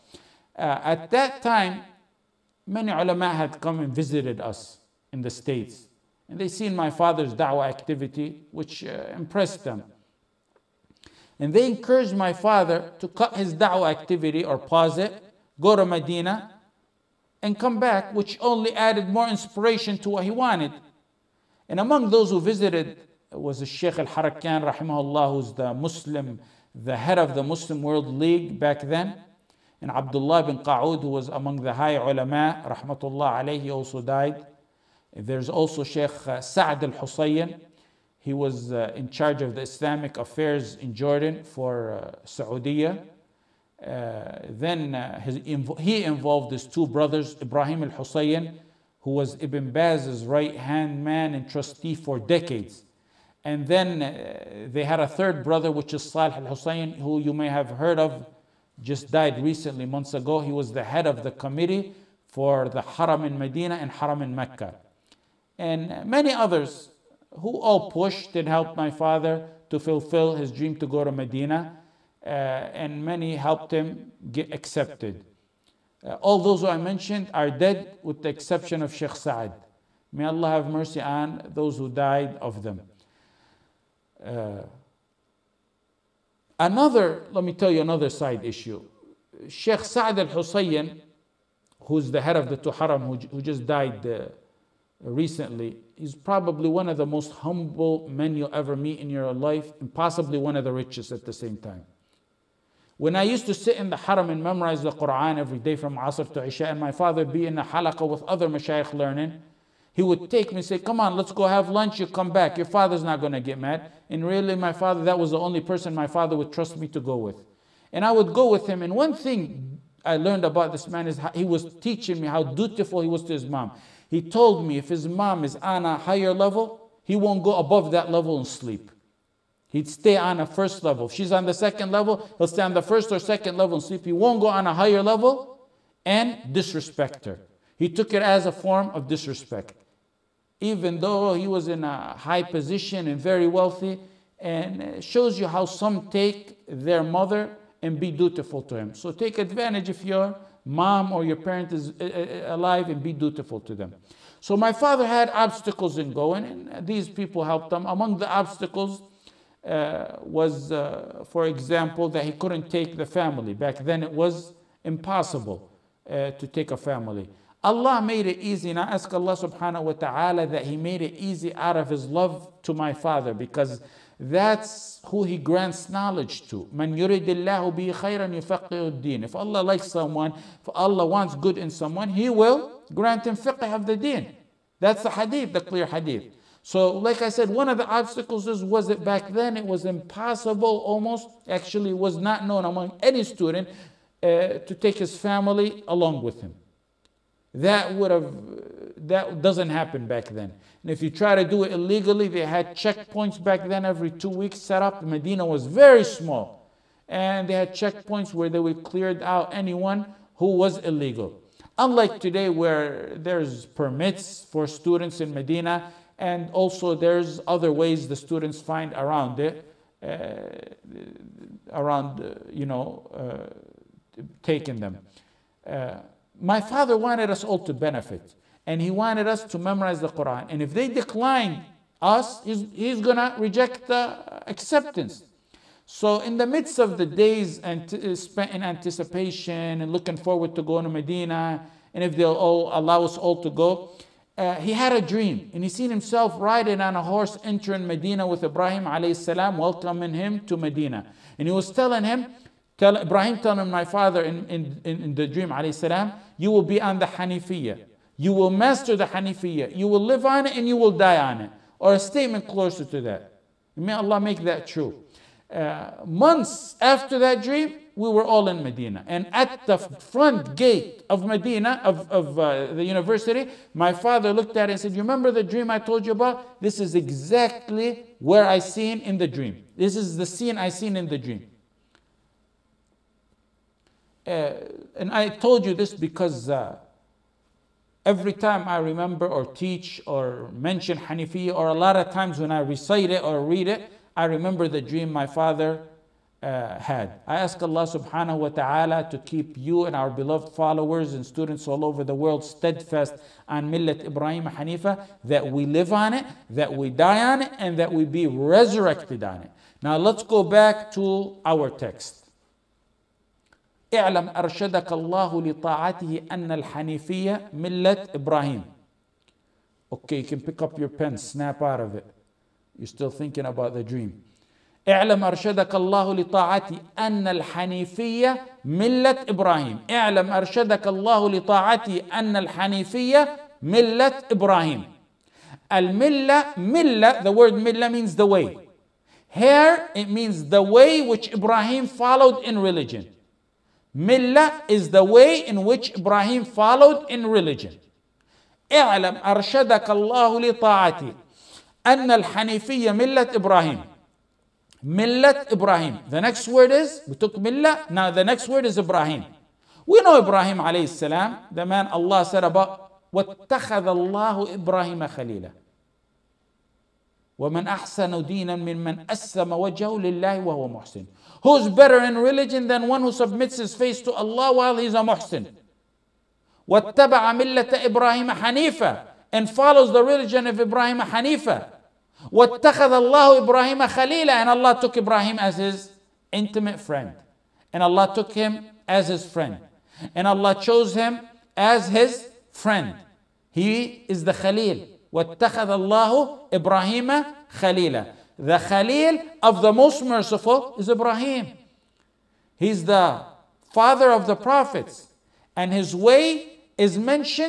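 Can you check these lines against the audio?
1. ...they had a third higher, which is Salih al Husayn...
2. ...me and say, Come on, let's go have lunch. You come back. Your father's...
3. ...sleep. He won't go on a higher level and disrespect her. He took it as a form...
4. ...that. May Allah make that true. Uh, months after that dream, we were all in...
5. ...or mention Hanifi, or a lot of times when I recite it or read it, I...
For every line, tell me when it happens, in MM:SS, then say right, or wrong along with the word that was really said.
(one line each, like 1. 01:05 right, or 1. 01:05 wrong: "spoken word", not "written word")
1. 00:54 wrong: "brother", not "higher"
2. 01:50 right
3. 02:13 right
4. 04:23 right
5. 04:50 right.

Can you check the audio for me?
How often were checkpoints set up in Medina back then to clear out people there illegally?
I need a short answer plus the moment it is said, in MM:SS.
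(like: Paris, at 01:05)
Every two weeks, at 03:23.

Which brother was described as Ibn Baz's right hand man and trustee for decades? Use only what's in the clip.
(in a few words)
Ibrahim al Husayn.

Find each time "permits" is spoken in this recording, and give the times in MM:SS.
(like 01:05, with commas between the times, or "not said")
03:33.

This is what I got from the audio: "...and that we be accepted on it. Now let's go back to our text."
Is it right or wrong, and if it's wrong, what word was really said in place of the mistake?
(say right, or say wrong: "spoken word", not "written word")
wrong: "resurrected", not "accepted".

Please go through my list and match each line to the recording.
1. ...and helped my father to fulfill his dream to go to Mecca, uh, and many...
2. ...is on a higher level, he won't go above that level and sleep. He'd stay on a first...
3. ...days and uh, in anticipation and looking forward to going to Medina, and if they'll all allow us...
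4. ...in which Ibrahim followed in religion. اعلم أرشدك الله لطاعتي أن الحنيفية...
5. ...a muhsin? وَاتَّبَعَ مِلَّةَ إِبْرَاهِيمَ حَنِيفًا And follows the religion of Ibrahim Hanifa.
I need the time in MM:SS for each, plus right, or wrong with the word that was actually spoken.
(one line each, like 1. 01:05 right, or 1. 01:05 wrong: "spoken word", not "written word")
1. 01:08 wrong: "Medina", not "Mecca"
2. 02:05 right
3. 03:57 right
4. 05:45 right
5. 06:14 right.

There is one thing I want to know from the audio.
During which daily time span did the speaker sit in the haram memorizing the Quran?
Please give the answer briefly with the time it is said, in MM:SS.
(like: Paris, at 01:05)
From Asr to Isha, at 01:45.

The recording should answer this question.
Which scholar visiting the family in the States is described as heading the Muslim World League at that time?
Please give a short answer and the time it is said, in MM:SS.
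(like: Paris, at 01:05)
Sheikh al Harakan, at 00:23.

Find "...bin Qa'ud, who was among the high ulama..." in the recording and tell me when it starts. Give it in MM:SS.
00:30.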